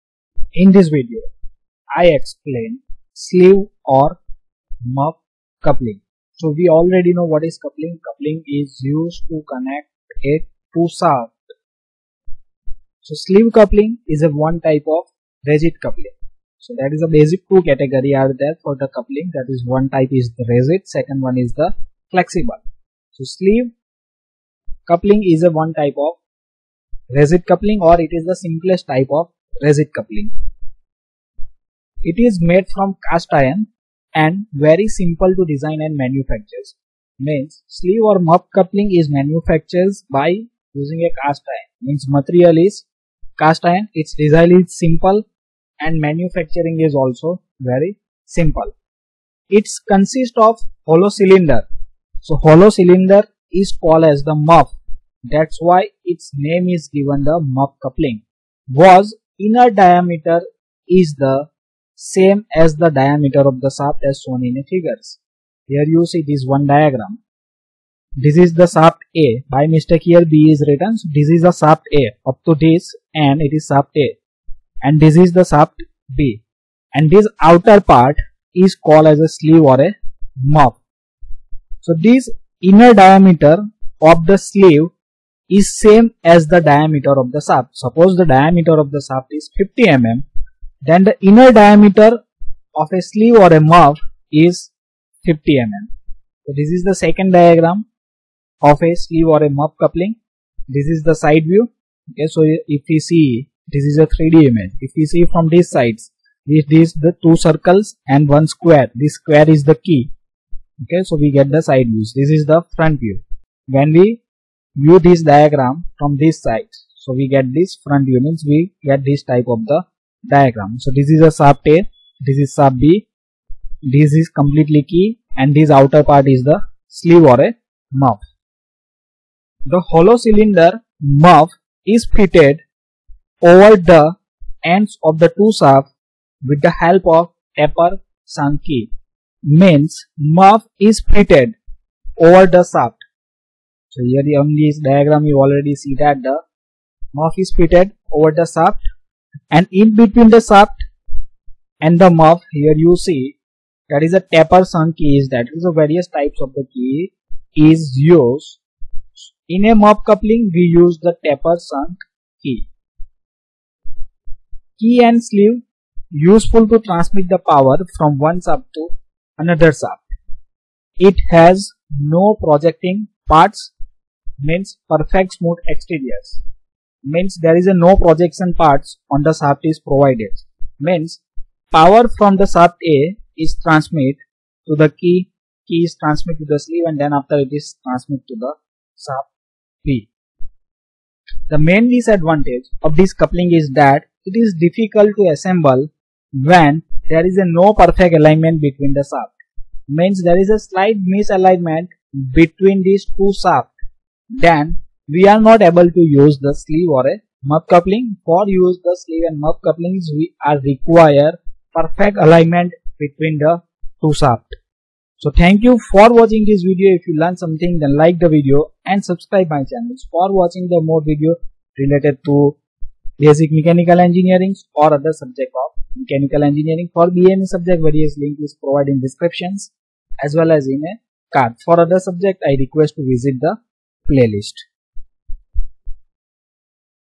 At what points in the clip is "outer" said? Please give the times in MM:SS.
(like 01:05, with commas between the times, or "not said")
01:17, 02:05.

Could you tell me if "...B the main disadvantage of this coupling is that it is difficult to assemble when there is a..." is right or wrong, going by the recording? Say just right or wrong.
right.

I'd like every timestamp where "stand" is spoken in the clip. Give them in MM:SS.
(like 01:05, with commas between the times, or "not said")
not said.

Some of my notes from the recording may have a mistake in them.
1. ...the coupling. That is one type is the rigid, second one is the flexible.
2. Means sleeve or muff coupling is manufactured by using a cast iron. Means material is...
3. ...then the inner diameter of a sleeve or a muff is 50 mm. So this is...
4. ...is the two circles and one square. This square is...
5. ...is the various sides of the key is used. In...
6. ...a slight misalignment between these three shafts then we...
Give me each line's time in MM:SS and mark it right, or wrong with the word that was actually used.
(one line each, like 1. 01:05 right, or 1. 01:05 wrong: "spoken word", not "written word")
1. 00:18 right
2. 00:37 right
3. 01:30 right
4. 01:46 right
5. 02:35 wrong: "types", not "sides"
6. 03:20 wrong: "two", not "three".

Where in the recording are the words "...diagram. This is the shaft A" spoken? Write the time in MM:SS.
01:06.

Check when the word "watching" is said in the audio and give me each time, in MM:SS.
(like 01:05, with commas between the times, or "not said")
03:36, 03:40.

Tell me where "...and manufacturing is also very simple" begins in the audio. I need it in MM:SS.
00:45.